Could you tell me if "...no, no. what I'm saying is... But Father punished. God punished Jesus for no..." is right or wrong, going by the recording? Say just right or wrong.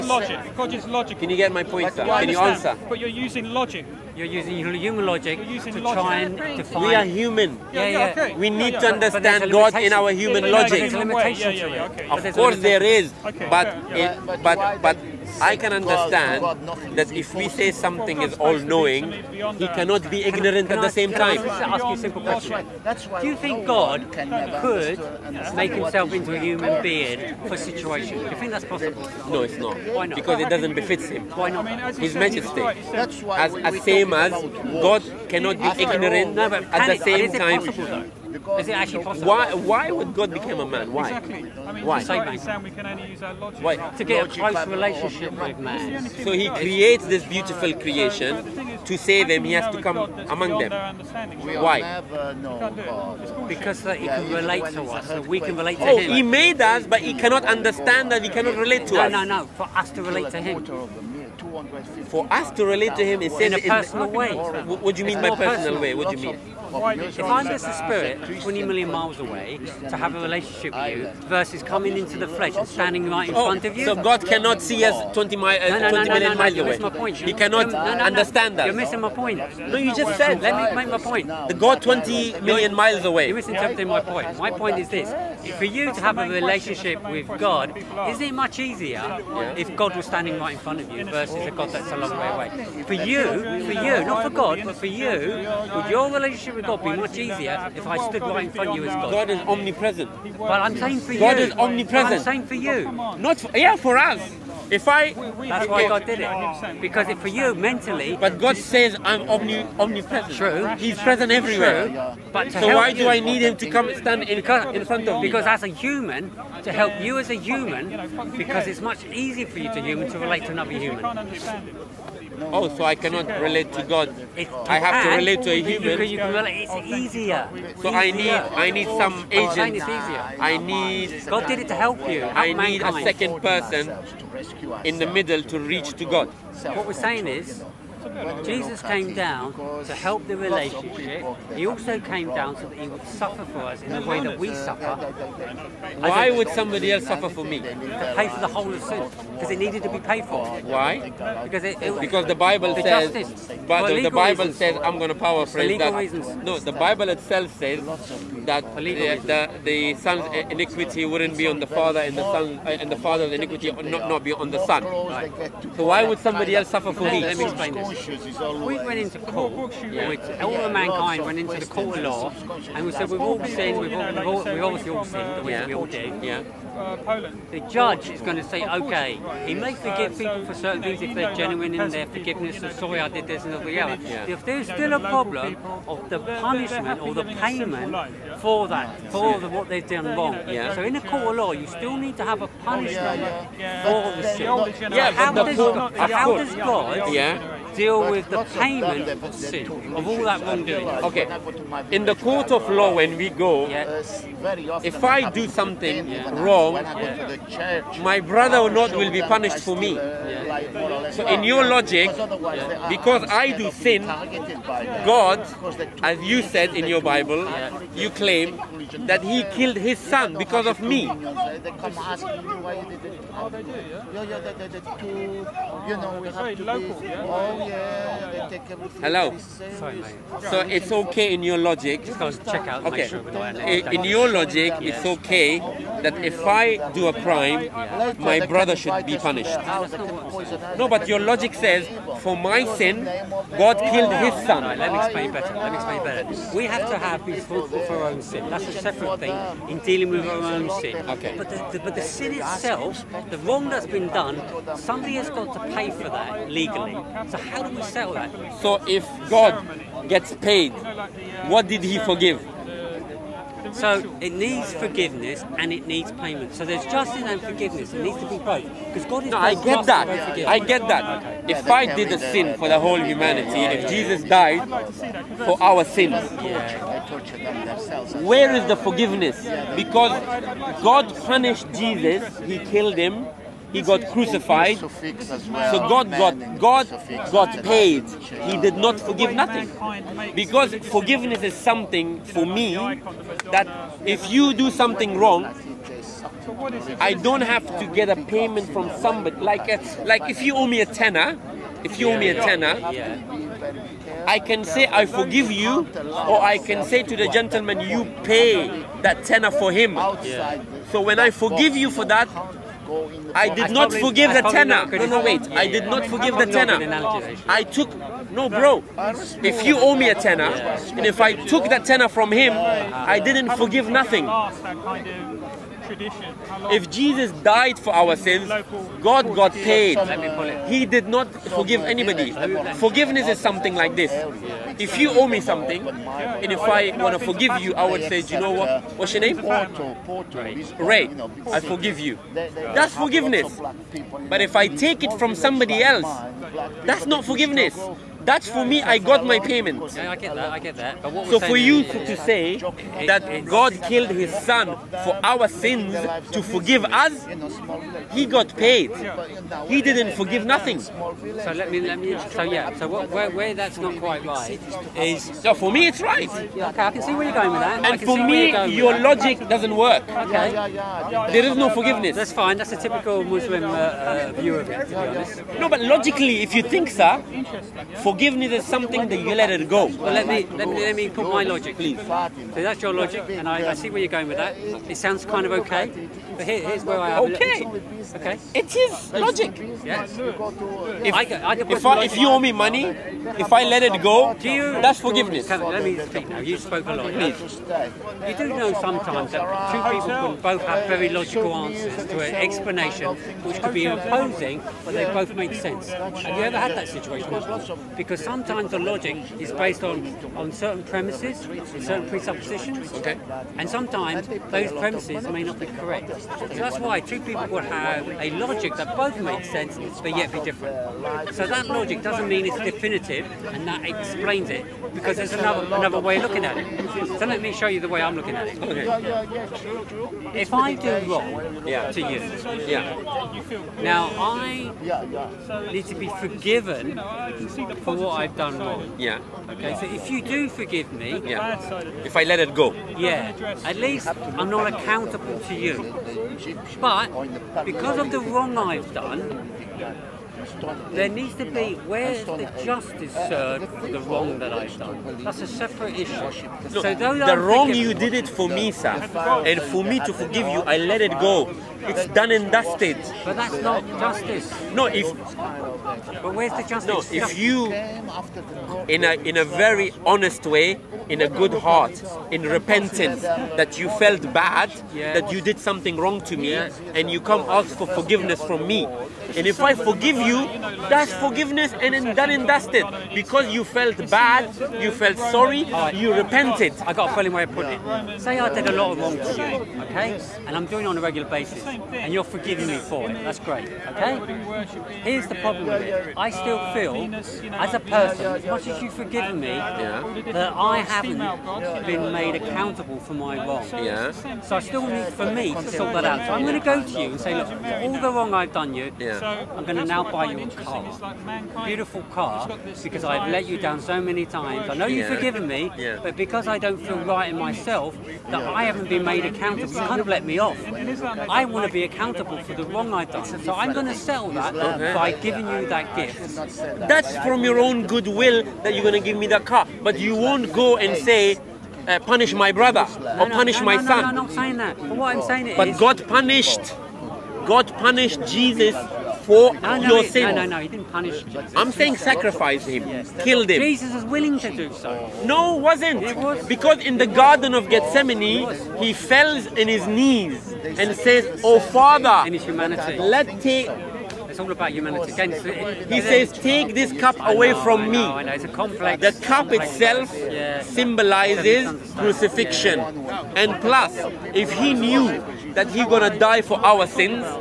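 wrong.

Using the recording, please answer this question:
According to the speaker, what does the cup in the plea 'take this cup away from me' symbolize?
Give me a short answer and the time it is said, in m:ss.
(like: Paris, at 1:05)
Crucifixion, at 9:21.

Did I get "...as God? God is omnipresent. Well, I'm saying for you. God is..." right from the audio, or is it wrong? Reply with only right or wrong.
right.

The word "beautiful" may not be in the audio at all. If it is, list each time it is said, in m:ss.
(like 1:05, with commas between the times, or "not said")
0:47, 8:31.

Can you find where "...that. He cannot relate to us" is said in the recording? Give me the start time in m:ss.
0:58.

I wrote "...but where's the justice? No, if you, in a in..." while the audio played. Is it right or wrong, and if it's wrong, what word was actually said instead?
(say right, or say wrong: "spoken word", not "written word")
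right.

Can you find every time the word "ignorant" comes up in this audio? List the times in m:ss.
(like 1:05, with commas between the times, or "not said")
0:20, 0:35.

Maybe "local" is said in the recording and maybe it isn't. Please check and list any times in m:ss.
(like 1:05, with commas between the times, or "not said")
3:46.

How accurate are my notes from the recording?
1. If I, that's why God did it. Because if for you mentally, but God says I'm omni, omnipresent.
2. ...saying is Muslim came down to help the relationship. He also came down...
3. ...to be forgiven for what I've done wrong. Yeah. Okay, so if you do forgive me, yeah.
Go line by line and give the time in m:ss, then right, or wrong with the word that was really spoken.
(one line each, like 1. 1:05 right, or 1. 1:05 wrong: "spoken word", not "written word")
1. 1:44 right
2. 2:16 wrong: "Jesus", not "Muslim"
3. 7:15 right.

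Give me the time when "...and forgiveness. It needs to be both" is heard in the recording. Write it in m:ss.
4:27.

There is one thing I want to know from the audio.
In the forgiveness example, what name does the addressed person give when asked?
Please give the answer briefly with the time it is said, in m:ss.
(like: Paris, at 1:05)
Ray, at 5:40.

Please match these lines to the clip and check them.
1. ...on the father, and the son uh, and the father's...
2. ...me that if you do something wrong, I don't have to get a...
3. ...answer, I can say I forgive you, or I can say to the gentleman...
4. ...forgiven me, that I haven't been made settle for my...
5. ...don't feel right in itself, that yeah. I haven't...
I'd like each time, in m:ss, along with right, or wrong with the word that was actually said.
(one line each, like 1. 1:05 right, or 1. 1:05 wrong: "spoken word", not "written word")
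1. 2:41 right
2. 4:52 right
3. 5:02 wrong: "tenner", not "answer"
4. 8:18 wrong: "accountable", not "settle"
5. 8:36 wrong: "myself", not "itself".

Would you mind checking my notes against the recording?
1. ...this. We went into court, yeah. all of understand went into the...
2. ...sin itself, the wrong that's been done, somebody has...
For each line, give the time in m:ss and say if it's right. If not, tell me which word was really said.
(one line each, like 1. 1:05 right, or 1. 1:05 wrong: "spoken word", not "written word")
1. 2:47 wrong: "mankind", not "understand"
2. 4:12 right.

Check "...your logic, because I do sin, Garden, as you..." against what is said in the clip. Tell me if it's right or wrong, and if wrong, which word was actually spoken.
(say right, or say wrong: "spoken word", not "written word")
wrong: "God", not "Garden".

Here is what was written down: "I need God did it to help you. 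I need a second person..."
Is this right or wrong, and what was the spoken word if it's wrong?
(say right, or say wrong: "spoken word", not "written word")
right.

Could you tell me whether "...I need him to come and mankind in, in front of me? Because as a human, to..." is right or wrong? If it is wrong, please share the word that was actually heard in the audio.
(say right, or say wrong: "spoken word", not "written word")
wrong: "stand", not "mankind".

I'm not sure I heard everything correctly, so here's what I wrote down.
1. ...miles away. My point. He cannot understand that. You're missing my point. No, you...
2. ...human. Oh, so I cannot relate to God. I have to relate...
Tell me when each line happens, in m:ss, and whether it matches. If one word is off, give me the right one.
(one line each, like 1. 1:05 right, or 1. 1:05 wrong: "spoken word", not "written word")
1. 1:16 right
2. 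2:00 right.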